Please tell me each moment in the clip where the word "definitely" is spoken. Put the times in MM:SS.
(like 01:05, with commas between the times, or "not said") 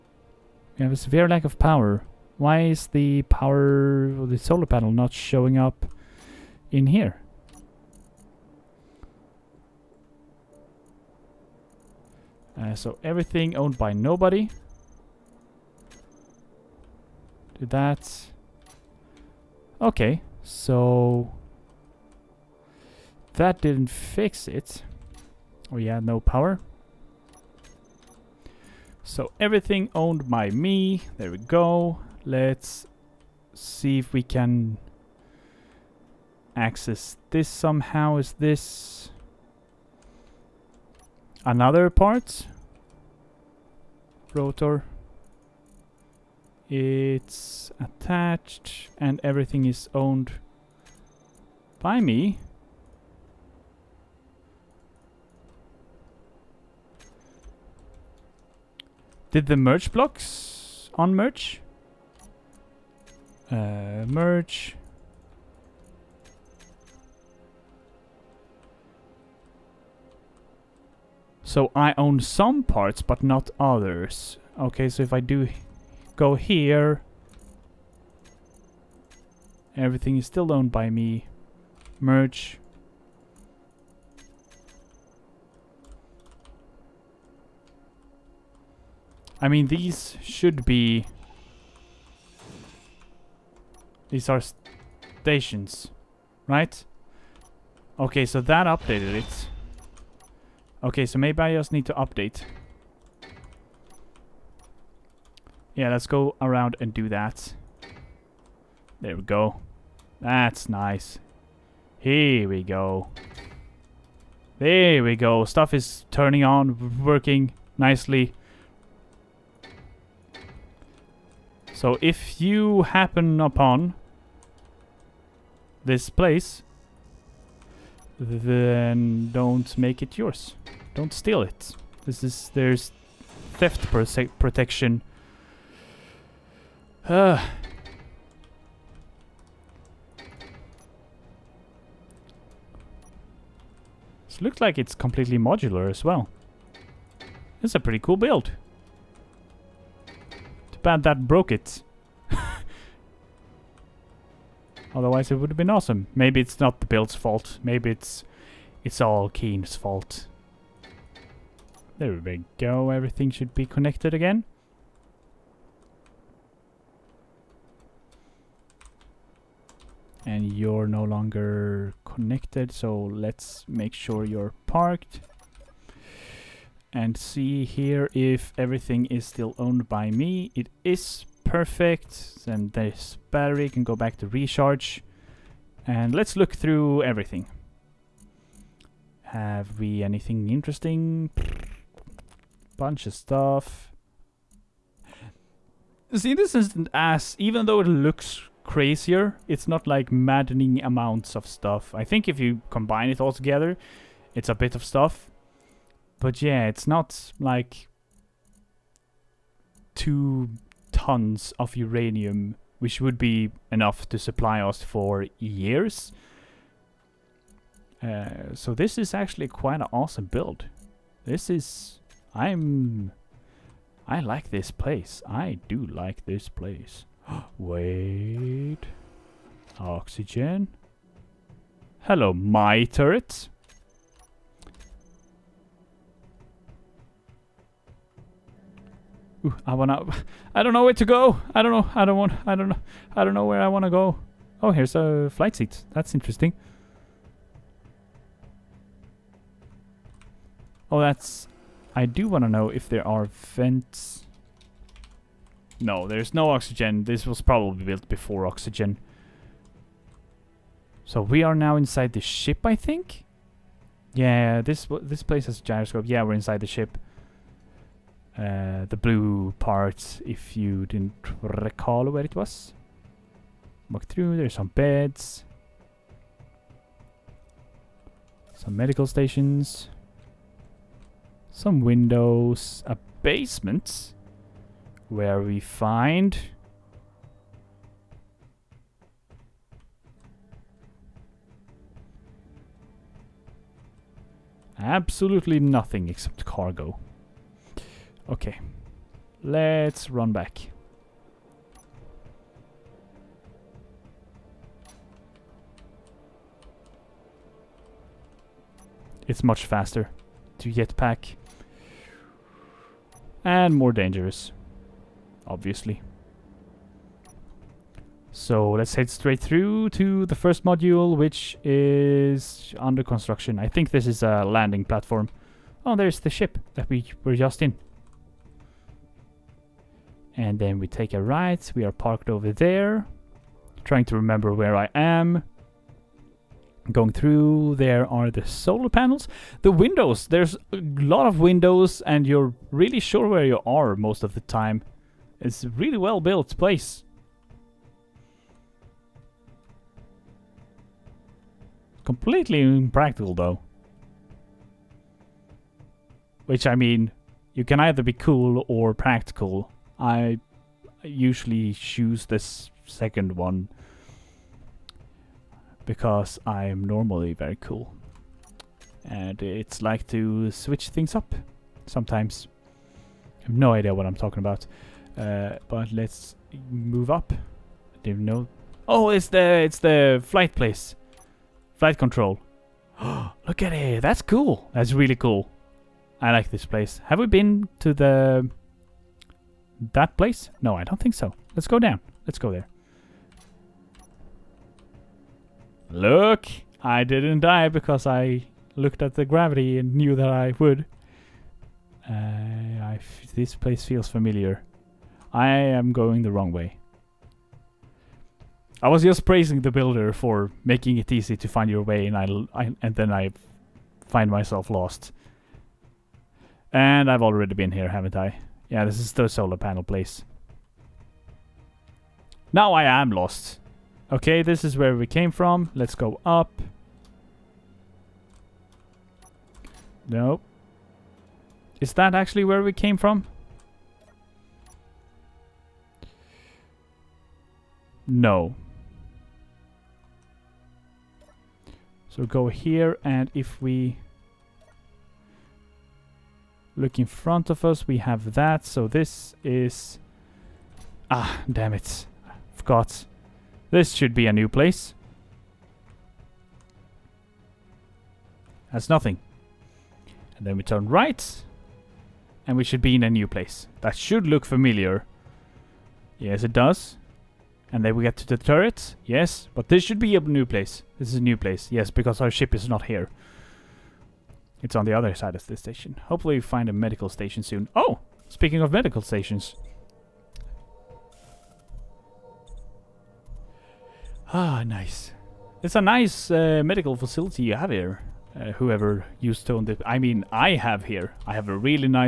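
not said.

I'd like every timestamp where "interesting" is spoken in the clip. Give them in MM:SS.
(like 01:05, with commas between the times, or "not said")
03:10, 04:06.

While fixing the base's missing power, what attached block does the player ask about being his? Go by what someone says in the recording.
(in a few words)
Rotor.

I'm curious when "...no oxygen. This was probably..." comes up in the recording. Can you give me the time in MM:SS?
04:16.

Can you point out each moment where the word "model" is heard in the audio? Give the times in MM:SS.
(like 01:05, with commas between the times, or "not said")
not said.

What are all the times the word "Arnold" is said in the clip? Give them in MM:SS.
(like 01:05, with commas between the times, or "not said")
not said.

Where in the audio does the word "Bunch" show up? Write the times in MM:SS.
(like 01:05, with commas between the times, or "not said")
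03:12.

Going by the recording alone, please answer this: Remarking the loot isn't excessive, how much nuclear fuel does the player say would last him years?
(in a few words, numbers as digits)
two tons of uranium.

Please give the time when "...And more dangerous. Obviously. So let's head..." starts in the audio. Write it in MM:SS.
05:13.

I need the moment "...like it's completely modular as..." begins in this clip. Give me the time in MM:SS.
02:24.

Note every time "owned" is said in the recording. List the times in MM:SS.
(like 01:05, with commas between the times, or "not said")
00:13, 00:29, 00:49, 01:20, 02:59.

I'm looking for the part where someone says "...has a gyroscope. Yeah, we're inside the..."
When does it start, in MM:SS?
04:25.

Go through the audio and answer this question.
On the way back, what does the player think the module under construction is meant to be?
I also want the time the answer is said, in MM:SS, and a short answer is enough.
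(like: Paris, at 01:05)
landing platform, at 05:24.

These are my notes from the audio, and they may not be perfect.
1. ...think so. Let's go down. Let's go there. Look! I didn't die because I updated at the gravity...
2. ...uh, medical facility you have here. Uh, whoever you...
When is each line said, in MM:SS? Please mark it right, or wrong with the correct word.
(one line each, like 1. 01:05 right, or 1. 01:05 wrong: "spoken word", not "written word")
1. 06:30 wrong: "looked", not "updated"
2. 08:06 right.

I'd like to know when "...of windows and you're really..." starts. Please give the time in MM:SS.
05:41.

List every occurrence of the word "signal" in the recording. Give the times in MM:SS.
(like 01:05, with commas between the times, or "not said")
not said.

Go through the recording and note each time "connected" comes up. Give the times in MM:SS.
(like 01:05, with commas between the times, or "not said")
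02:43, 02:52.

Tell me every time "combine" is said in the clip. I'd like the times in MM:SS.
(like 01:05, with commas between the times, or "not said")
03:22.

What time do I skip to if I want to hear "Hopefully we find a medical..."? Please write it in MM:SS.
07:56.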